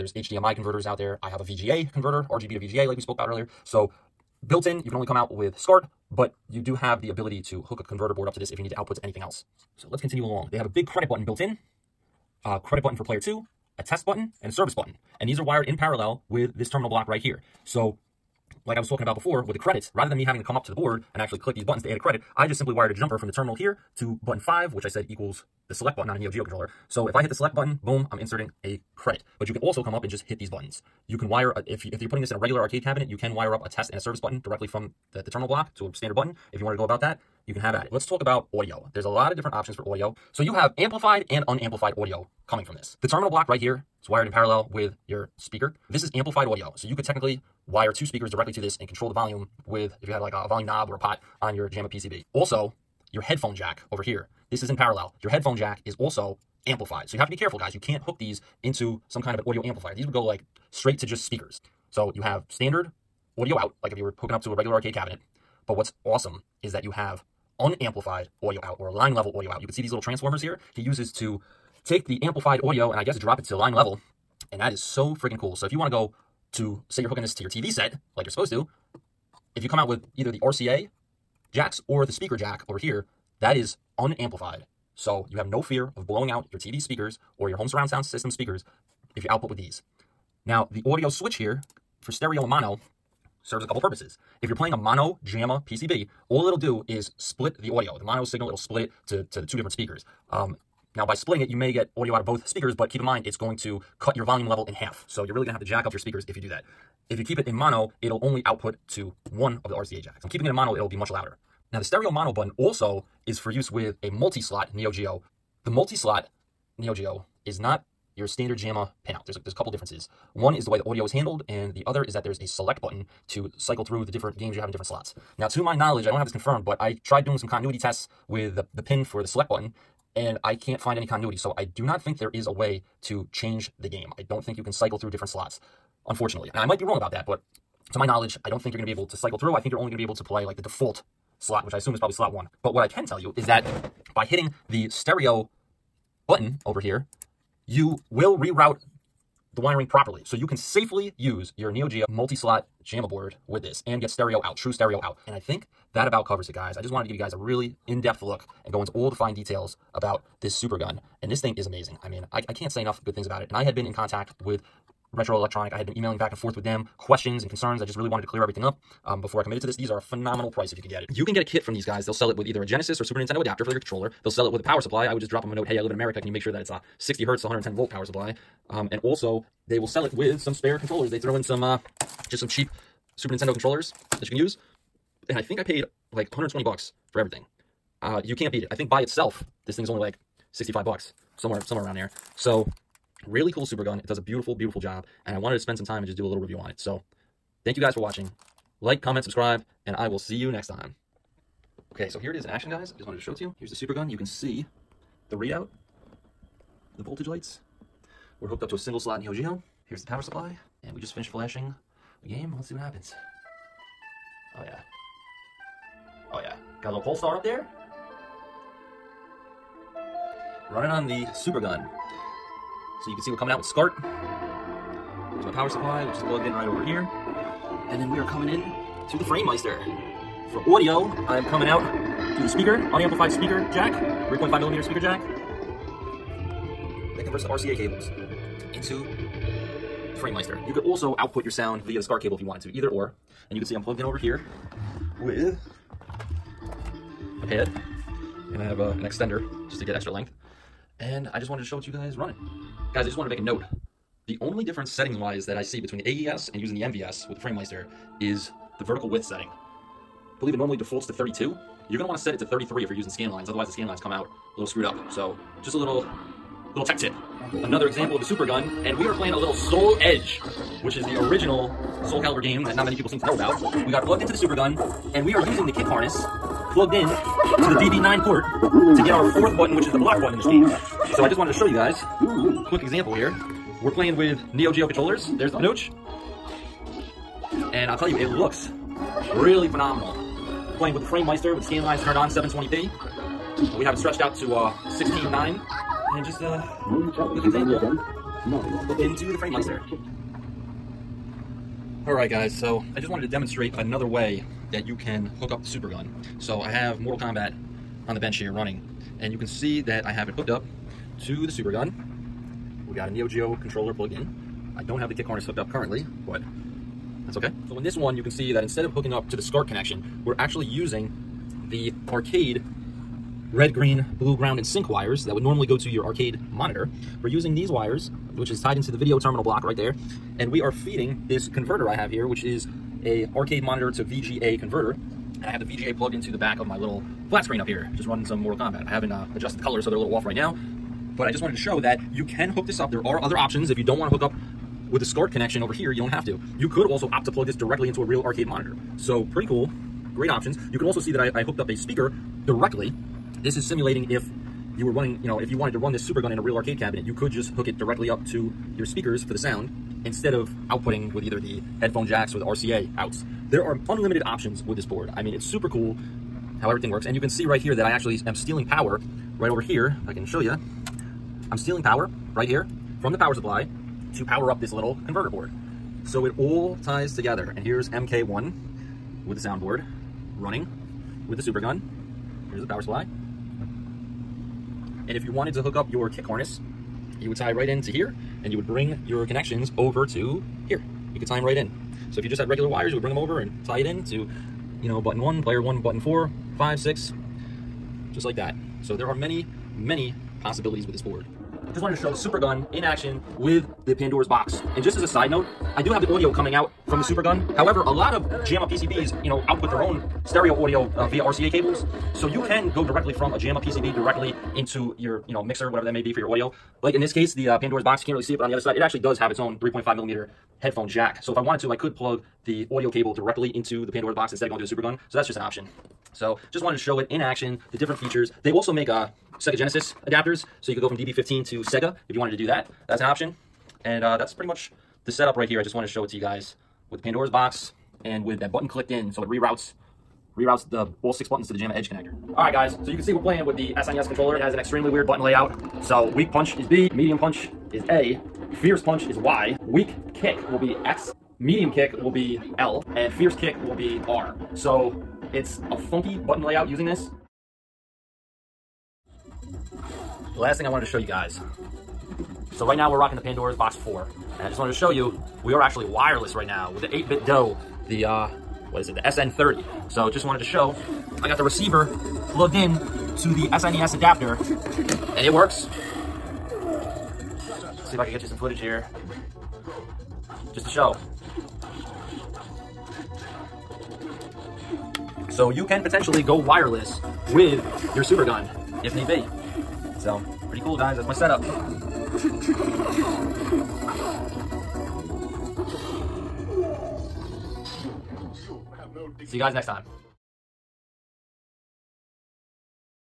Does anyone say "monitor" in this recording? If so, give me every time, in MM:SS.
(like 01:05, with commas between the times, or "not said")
05:26, 05:33, 05:48.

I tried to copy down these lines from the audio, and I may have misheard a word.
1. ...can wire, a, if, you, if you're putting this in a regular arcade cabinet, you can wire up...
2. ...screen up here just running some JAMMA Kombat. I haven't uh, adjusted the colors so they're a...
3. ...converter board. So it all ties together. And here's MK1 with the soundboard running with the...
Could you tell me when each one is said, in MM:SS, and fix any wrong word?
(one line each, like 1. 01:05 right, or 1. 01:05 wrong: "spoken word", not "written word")
1. 00:31 right
2. 05:37 wrong: "Mortal", not "JAMMA"
3. 06:15 right.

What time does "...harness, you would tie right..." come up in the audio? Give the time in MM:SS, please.
06:26.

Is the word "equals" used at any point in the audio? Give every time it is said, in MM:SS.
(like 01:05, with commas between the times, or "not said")
00:25.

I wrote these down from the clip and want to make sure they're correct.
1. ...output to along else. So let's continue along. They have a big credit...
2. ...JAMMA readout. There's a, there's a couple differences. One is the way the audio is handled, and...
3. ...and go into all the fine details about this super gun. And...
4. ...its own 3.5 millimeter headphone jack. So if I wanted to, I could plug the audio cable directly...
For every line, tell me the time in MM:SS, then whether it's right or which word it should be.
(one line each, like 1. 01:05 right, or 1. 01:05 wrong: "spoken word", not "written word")
1. 00:08 wrong: "anything", not "along"
2. 01:58 wrong: "pinout", not "readout"
3. 02:38 right
4. 06:59 right.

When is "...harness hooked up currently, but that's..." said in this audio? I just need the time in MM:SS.
05:15.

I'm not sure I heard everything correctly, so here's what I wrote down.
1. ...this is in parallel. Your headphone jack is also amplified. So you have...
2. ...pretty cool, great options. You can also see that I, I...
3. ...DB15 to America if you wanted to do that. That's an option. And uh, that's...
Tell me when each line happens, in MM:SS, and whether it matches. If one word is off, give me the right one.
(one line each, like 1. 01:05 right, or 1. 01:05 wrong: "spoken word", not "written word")
1. 00:54 right
2. 05:49 right
3. 07:10 wrong: "Sega", not "America".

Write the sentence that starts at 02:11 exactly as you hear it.
So I do not think there is a way to change the game.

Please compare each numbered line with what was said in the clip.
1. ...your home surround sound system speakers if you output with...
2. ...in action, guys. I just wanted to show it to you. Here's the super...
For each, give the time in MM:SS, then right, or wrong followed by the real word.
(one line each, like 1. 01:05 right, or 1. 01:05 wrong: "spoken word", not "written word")
1. 01:27 right
2. 03:22 right.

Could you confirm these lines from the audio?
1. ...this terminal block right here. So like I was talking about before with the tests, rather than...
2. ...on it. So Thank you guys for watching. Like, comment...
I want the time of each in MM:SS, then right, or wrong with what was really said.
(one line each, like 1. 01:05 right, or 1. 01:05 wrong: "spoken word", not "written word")
1. 00:16 wrong: "credits", not "tests"
2. 03:16 right.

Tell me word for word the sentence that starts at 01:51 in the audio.
Now the stereo mono button also is for use with a multi-slot Neo Geo.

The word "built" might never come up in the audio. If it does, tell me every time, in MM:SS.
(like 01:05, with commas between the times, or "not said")
00:04, 00:11.